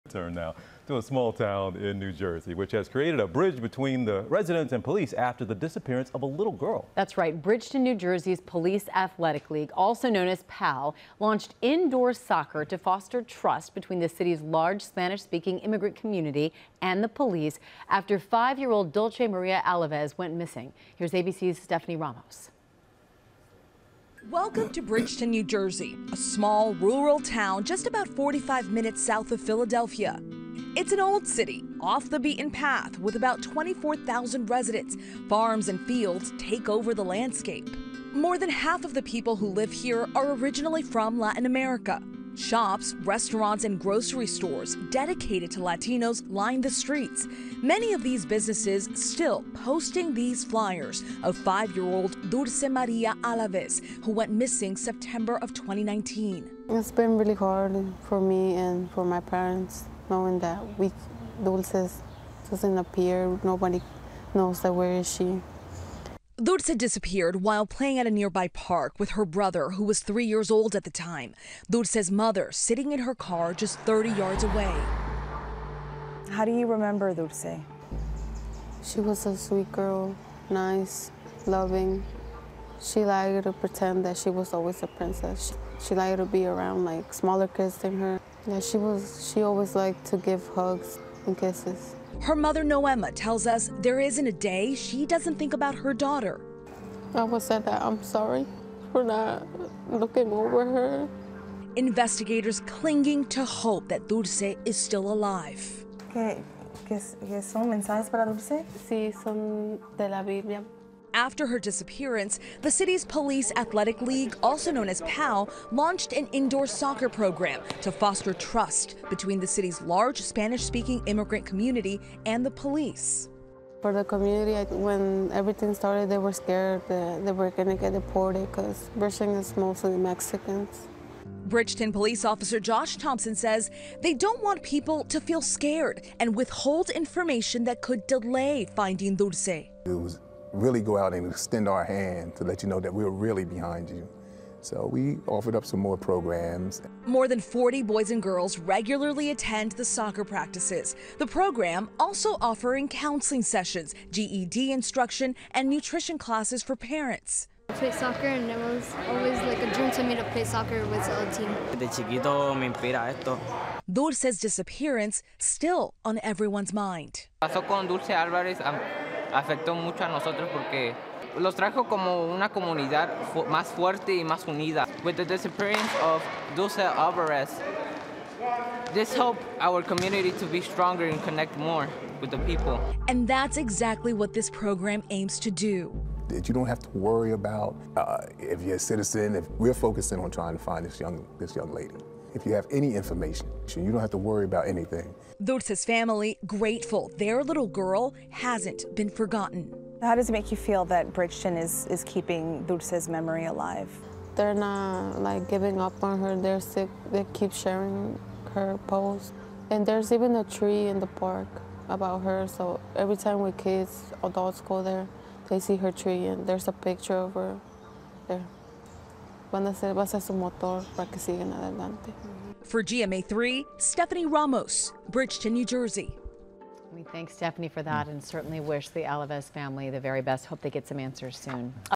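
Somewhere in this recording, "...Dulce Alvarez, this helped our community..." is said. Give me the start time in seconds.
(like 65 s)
176 s.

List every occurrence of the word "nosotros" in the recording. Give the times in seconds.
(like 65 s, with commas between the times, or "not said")
170 s.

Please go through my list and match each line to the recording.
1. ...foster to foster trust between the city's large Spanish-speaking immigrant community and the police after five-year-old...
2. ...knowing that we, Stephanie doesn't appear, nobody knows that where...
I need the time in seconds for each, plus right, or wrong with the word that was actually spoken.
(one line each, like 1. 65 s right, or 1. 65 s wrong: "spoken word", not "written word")
1. 12 s wrong: "soccer", not "foster"
2. 60 s wrong: "Dulce", not "Stephanie".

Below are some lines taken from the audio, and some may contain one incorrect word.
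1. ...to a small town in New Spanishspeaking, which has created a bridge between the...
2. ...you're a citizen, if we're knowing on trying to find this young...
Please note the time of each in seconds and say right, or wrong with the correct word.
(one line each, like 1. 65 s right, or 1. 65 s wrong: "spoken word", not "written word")
1. 0 s wrong: "Jersey", not "Spanishspeaking"
2. 188 s wrong: "focusing", not "knowing".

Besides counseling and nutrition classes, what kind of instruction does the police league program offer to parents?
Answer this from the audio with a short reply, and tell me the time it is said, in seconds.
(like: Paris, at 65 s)
GED instruction, at 154 s.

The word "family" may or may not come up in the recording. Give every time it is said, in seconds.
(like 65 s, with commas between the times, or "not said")
195 s, 229 s.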